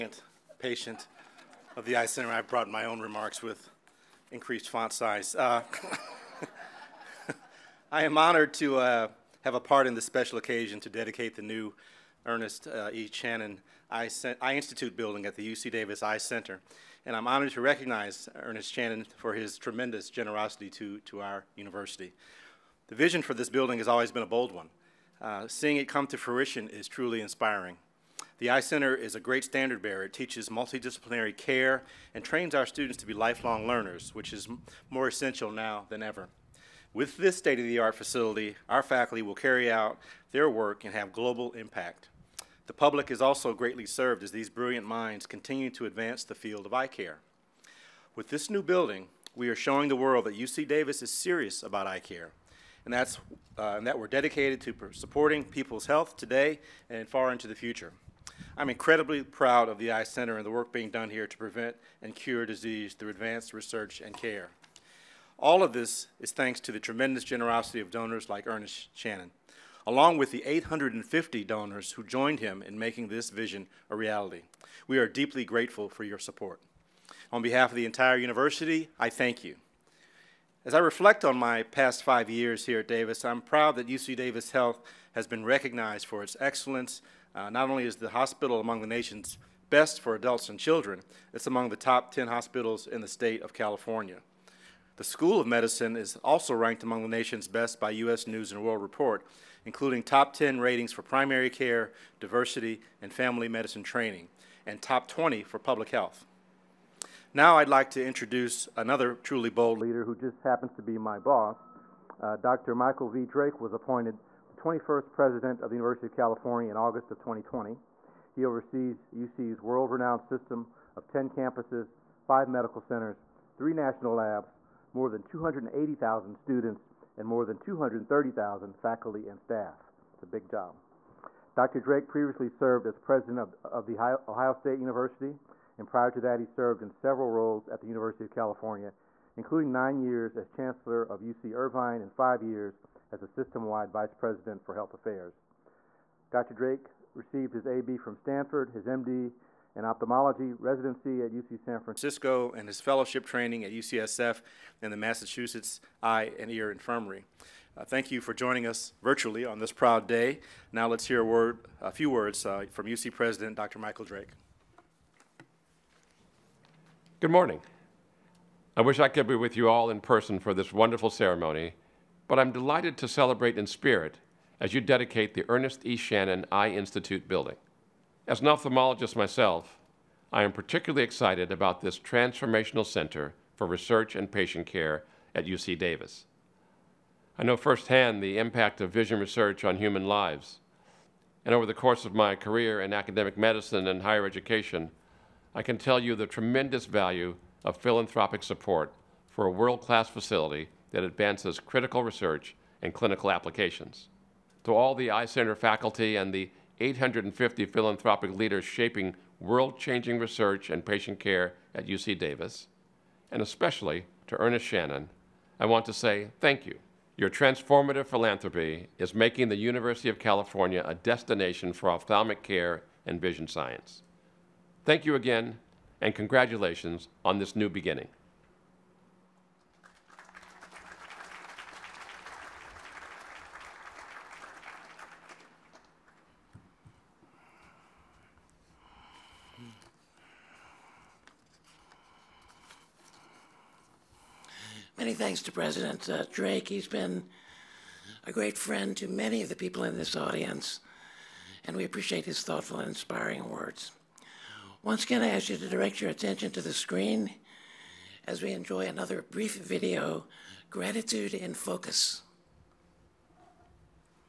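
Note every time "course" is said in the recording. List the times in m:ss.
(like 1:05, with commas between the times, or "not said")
3:11.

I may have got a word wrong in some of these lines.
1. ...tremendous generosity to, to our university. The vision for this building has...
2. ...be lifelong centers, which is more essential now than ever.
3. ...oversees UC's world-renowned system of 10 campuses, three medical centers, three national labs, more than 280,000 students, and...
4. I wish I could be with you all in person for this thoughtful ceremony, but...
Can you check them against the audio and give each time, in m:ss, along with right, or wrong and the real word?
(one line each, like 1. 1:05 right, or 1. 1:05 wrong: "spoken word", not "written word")
1. 0:19 right
2. 0:33 wrong: "learners", not "centers"
3. 1:58 wrong: "five", not "three"
4. 2:48 wrong: "wonderful", not "thoughtful".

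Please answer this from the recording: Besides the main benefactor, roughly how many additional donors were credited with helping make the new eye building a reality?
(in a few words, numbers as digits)
850.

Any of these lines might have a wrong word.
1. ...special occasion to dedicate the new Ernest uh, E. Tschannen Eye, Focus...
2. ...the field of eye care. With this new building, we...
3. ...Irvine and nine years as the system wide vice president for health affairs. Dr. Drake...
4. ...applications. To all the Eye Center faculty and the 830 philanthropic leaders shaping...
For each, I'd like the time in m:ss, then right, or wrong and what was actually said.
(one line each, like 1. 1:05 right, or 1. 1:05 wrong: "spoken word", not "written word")
1. 0:10 wrong: "Eye", not "Focus"
2. 0:46 right
3. 2:21 wrong: "five", not "nine"
4. 3:23 wrong: "850", not "830".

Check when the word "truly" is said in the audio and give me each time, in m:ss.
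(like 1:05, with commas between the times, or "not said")
0:26, 1:49.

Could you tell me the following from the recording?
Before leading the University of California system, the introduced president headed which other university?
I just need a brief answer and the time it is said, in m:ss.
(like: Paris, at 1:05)
Ohio State University, at 2:14.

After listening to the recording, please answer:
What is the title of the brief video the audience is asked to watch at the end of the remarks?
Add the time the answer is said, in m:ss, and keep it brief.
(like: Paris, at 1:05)
Gratitude in Focus, at 4:20.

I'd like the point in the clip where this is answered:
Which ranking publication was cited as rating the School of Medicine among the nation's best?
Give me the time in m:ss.
1:37.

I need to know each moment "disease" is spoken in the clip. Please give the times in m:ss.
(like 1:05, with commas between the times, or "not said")
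1:02.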